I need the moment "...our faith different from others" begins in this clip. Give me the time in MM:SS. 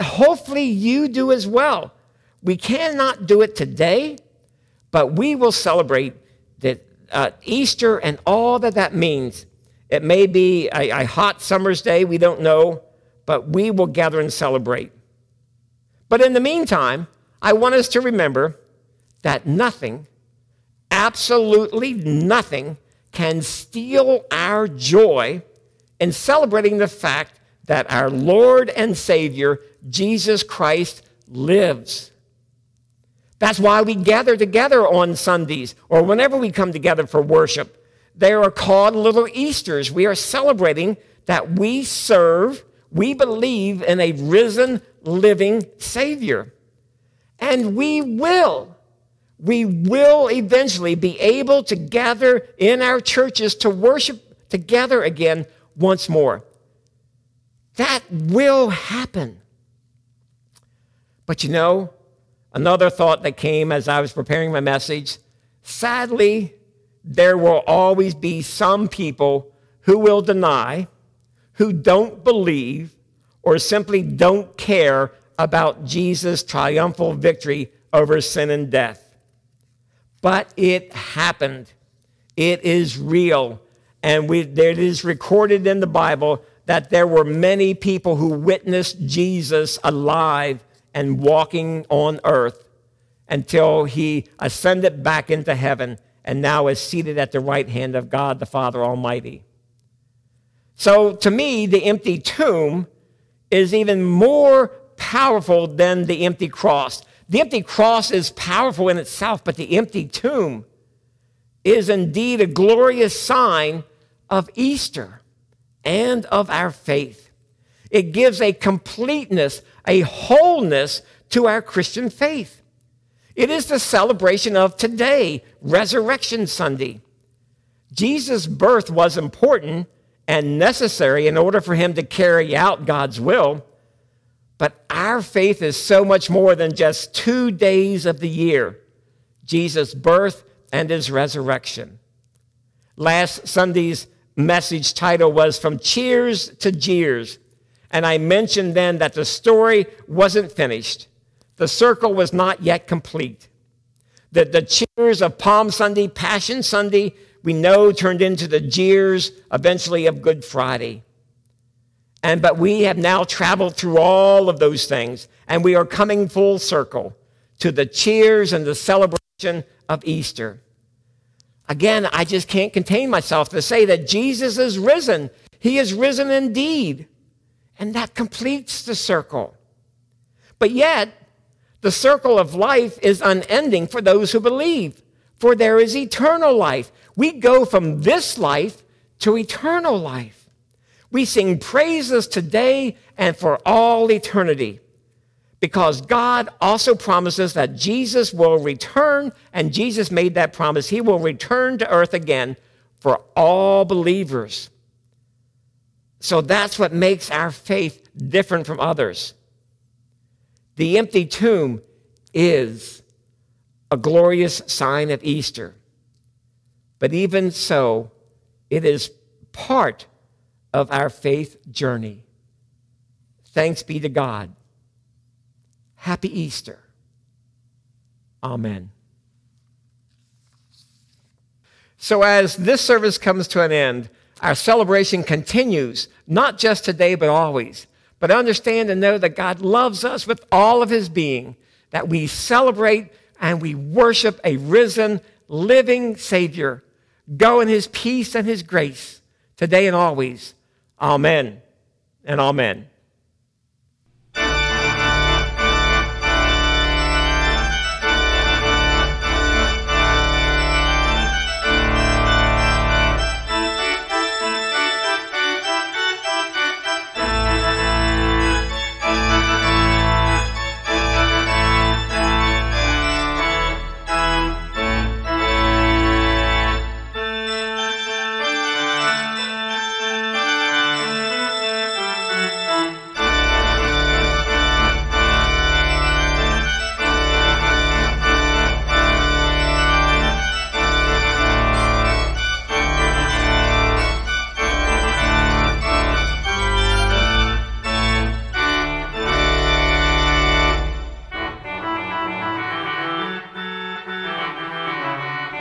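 03:27.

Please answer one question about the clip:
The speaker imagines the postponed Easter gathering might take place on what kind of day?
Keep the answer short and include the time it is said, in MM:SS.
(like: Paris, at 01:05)
A hot summer's day, at 00:11.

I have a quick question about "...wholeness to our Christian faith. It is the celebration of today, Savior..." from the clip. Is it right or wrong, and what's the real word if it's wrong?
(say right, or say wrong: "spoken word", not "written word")
wrong: "Resurrection", not "Savior".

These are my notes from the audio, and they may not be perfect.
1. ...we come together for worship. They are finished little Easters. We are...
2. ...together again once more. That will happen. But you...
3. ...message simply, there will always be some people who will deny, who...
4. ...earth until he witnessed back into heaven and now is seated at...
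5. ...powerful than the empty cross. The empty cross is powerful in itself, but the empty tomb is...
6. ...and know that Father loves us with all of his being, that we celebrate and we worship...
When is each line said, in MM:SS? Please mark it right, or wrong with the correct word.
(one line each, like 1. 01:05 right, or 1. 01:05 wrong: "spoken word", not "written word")
1. 00:36 wrong: "called", not "finished"
2. 00:54 right
3. 01:04 wrong: "sadly", not "simply"
4. 01:32 wrong: "ascended", not "witnessed"
5. 01:44 right
6. 03:58 wrong: "God", not "Father".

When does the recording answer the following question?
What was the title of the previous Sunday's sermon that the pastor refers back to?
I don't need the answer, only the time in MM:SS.
02:25.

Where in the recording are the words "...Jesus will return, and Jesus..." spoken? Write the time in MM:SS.
03:17.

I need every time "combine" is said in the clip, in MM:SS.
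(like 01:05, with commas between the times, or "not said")
not said.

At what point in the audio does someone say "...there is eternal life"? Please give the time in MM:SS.
03:05.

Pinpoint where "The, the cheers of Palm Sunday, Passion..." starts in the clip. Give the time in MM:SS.
02:34.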